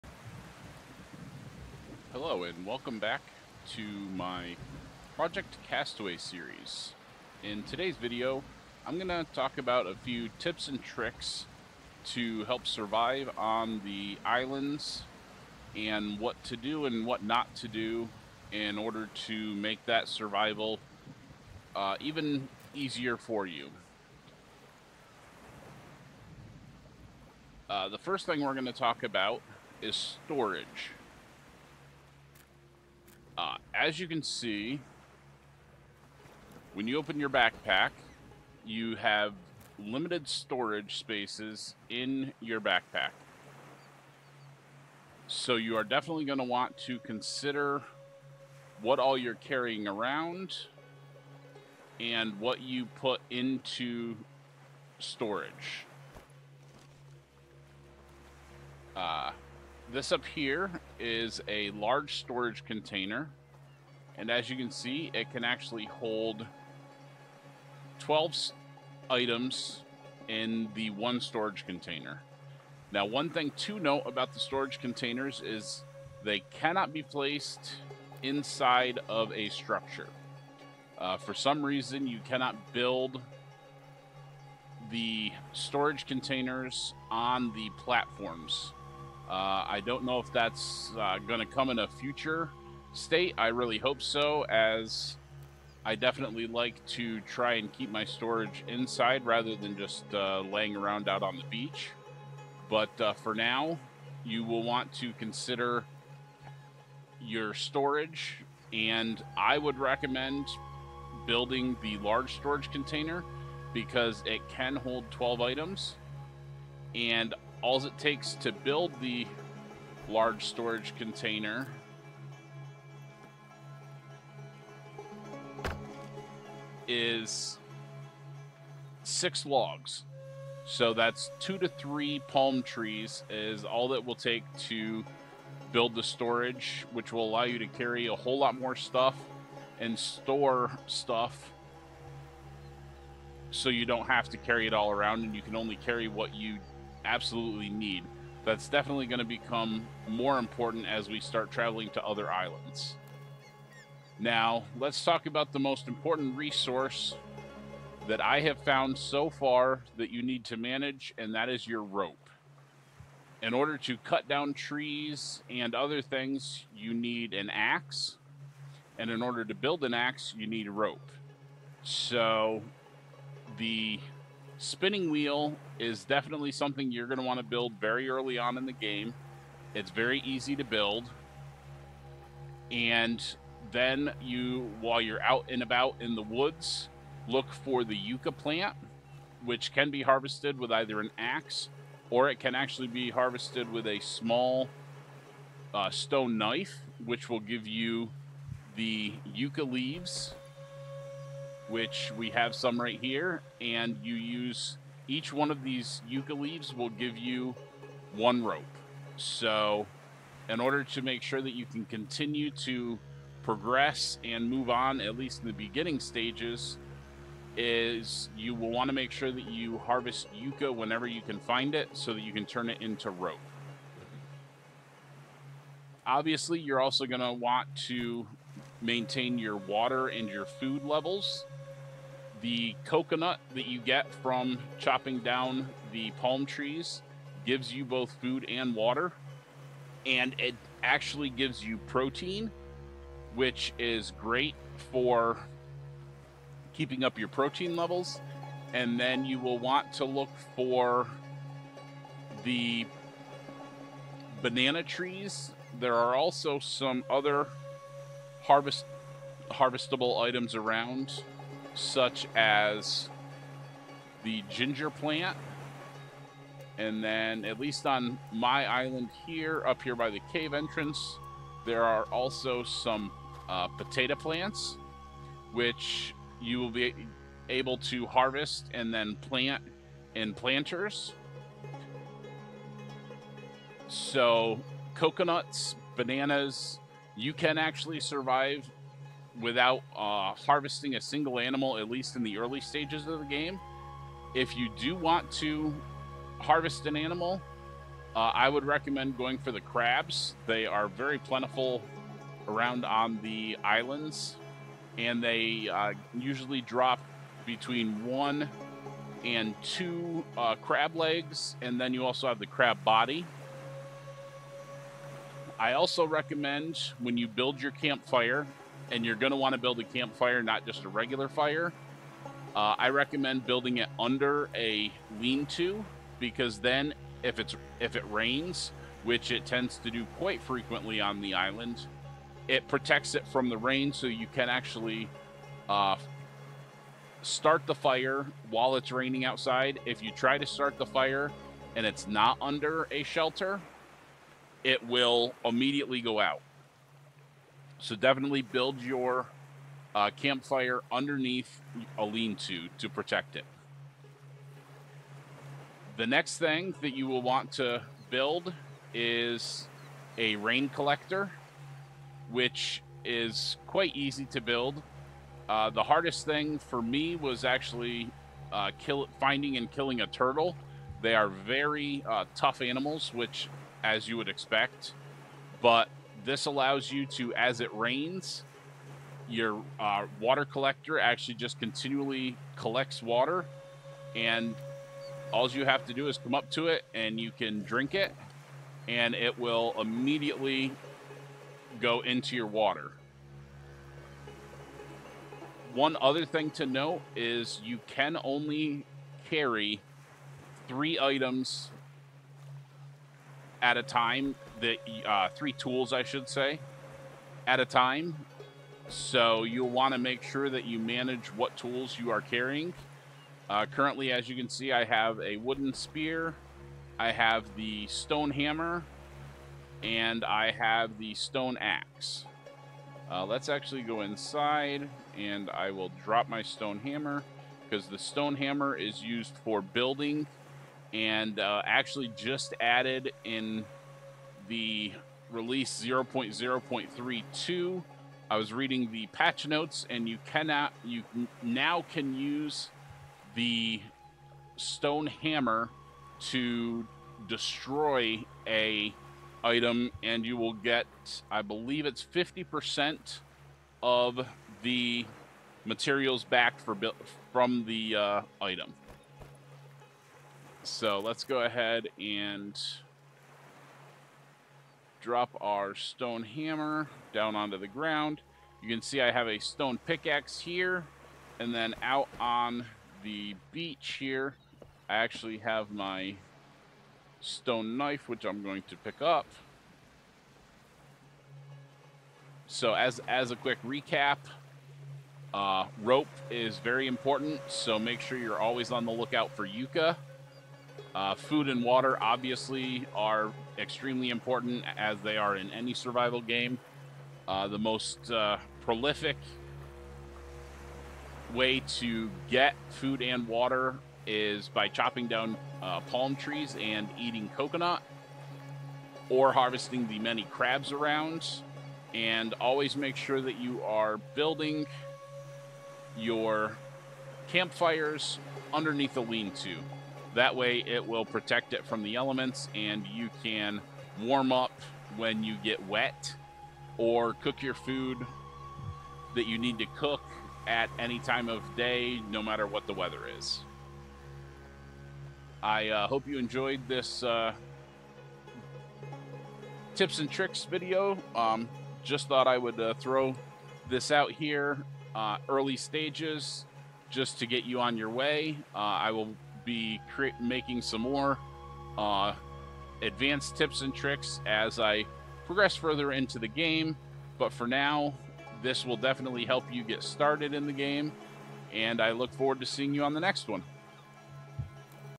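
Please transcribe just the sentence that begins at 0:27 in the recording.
Uh, the first thing we're going to talk about is storage.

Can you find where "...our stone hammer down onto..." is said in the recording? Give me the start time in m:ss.
7:45.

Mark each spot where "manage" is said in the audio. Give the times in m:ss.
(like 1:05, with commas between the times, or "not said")
2:40, 6:50.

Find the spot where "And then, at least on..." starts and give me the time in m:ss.
4:26.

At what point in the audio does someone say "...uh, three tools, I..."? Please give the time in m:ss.
6:45.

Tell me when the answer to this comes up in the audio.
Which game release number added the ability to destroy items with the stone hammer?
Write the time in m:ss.
7:15.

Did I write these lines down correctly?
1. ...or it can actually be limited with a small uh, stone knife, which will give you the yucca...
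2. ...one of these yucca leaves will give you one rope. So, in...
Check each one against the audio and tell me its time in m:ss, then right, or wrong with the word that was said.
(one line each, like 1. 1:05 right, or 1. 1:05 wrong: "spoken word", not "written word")
1. 3:12 wrong: "harvested", not "limited"
2. 3:25 right.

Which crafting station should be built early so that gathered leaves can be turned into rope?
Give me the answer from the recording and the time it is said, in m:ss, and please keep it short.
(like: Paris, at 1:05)
spinning wheel, at 2:54.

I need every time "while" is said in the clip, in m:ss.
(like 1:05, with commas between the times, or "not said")
3:04, 5:38.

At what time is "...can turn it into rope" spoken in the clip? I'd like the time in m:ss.
3:42.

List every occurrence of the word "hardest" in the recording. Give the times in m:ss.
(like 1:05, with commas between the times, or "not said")
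6:05.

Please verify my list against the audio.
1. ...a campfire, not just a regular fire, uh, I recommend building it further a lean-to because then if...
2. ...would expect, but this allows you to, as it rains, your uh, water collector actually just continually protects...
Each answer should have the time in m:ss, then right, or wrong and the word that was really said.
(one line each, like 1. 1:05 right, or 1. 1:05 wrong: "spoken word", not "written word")
1. 5:19 wrong: "under", not "further"
2. 6:14 wrong: "collects", not "protects".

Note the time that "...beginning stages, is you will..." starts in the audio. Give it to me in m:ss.
3:35.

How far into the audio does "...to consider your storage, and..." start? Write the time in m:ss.
1:44.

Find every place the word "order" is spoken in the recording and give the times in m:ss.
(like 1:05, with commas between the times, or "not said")
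0:18, 2:43, 2:49, 3:30.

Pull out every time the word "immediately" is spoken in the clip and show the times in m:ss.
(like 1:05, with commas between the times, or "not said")
5:45, 6:29.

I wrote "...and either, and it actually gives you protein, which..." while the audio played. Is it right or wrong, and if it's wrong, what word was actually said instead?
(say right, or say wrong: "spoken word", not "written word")
wrong: "water", not "either".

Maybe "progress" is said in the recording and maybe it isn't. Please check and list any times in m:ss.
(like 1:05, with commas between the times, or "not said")
3:33, 9:15.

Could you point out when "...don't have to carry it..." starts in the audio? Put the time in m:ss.
2:23.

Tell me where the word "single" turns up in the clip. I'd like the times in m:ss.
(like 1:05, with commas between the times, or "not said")
4:51.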